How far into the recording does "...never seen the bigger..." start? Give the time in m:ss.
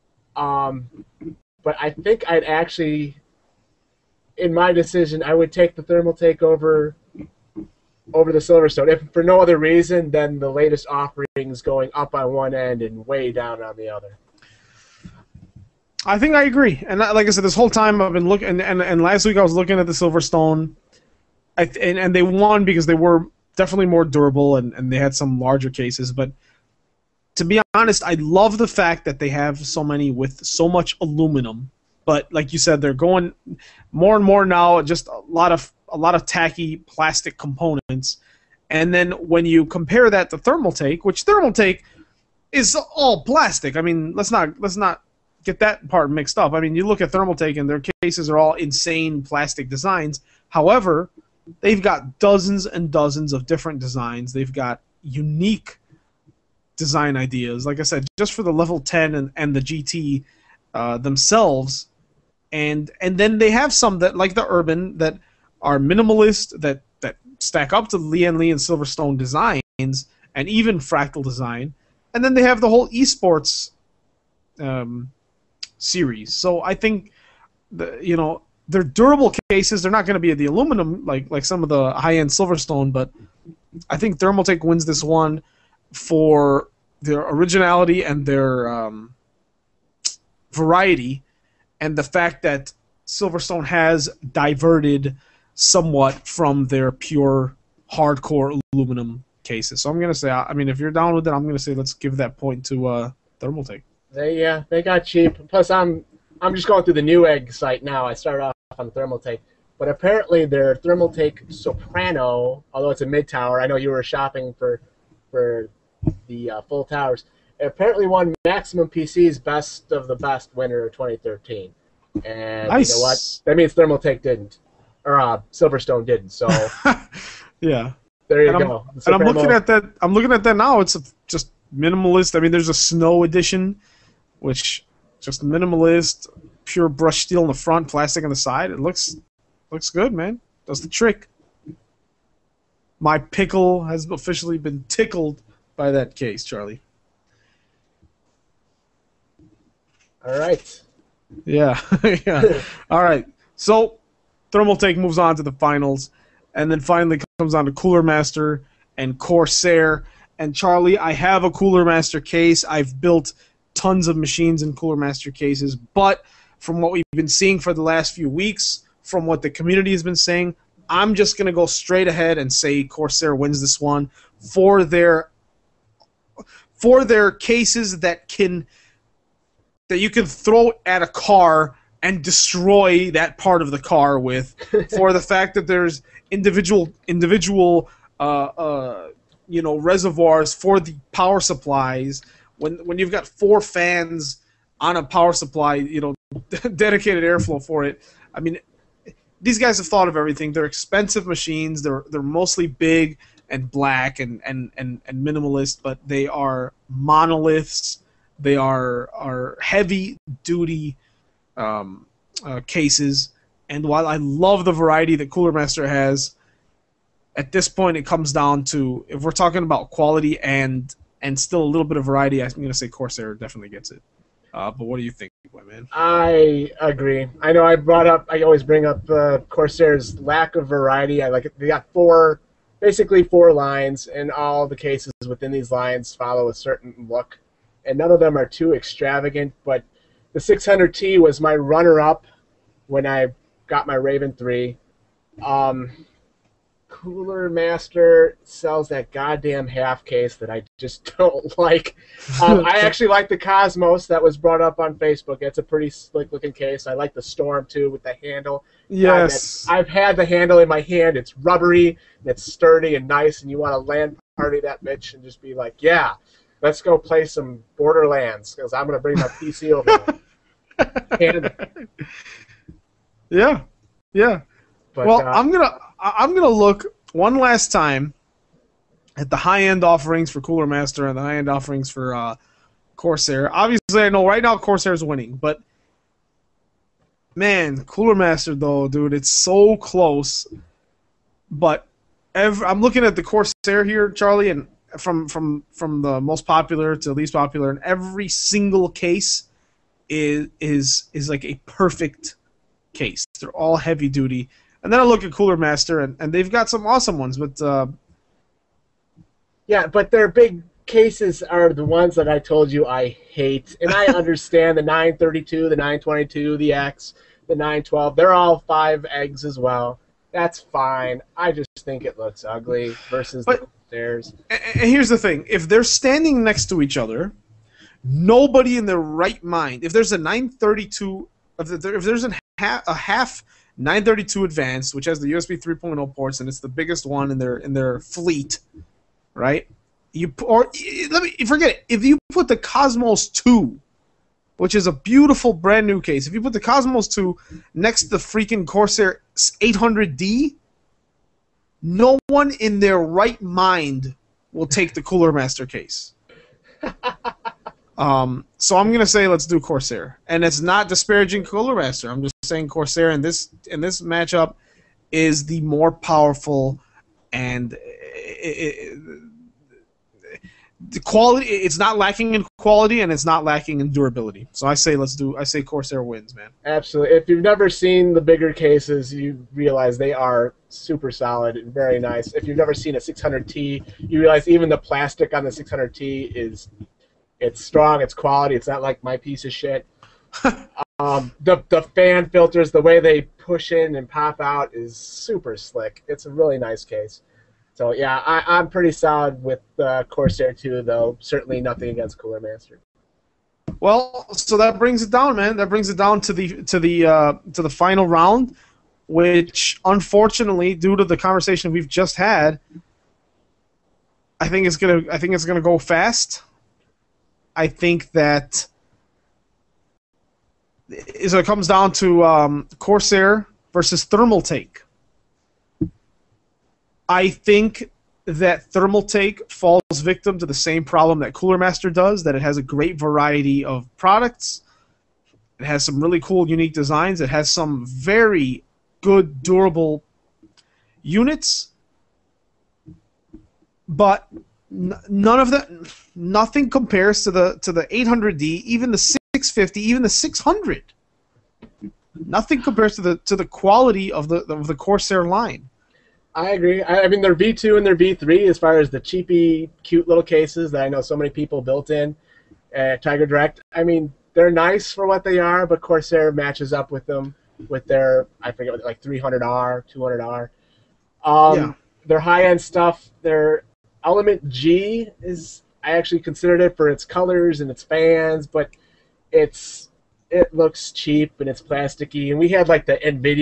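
6:17.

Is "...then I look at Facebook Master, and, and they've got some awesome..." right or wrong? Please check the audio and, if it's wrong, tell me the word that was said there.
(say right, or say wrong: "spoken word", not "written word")
wrong: "Cooler", not "Facebook".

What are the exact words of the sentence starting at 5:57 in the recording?
um, so I'm gonna say let's do Corsair, and it's not disparaging Cooler Master.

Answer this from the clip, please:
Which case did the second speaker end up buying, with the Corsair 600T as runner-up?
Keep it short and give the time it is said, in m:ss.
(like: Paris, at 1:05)
Raven 3, at 4:03.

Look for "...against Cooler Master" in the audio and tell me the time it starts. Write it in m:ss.
6:41.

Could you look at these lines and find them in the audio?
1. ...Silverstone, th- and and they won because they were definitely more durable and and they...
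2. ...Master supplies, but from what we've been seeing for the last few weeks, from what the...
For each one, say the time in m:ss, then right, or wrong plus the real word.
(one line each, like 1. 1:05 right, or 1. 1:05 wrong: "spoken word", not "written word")
1. 0:19 right
2. 2:44 wrong: "cases", not "supplies".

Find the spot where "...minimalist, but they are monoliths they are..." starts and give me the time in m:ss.
3:25.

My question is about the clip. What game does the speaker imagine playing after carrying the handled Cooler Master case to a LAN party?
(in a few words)
Borderlands.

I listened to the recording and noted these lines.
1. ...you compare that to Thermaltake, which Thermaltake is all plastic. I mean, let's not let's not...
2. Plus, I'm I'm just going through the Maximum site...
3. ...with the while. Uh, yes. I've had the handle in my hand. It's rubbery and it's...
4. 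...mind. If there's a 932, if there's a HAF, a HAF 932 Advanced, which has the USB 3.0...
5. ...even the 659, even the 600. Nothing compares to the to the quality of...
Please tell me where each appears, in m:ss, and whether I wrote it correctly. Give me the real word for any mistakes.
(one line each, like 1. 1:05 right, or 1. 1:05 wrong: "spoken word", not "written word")
1. 0:39 right
2. 1:45 wrong: "Newegg", not "Maximum"
3. 4:17 wrong: "handle", not "while"
4. 5:29 right
5. 7:28 wrong: "650", not "659".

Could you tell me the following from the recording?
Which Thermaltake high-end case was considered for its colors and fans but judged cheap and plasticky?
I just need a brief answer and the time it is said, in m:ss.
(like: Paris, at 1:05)
Element G, at 7:54.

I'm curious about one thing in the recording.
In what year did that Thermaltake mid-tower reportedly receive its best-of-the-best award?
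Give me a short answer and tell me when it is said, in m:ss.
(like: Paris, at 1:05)
2013, at 2:00.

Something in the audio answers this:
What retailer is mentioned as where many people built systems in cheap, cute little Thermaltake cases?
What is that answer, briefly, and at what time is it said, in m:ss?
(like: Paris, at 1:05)
TigerDirect, at 7:43.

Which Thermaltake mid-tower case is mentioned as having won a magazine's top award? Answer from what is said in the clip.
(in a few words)
Soprano.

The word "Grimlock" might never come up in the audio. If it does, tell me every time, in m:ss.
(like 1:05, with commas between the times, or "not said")
not said.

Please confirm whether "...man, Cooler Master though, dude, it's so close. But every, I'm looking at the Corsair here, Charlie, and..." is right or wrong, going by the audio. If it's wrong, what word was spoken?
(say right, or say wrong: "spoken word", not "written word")
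right.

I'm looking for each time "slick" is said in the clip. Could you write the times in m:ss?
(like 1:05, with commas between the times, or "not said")
4:15, 6:35.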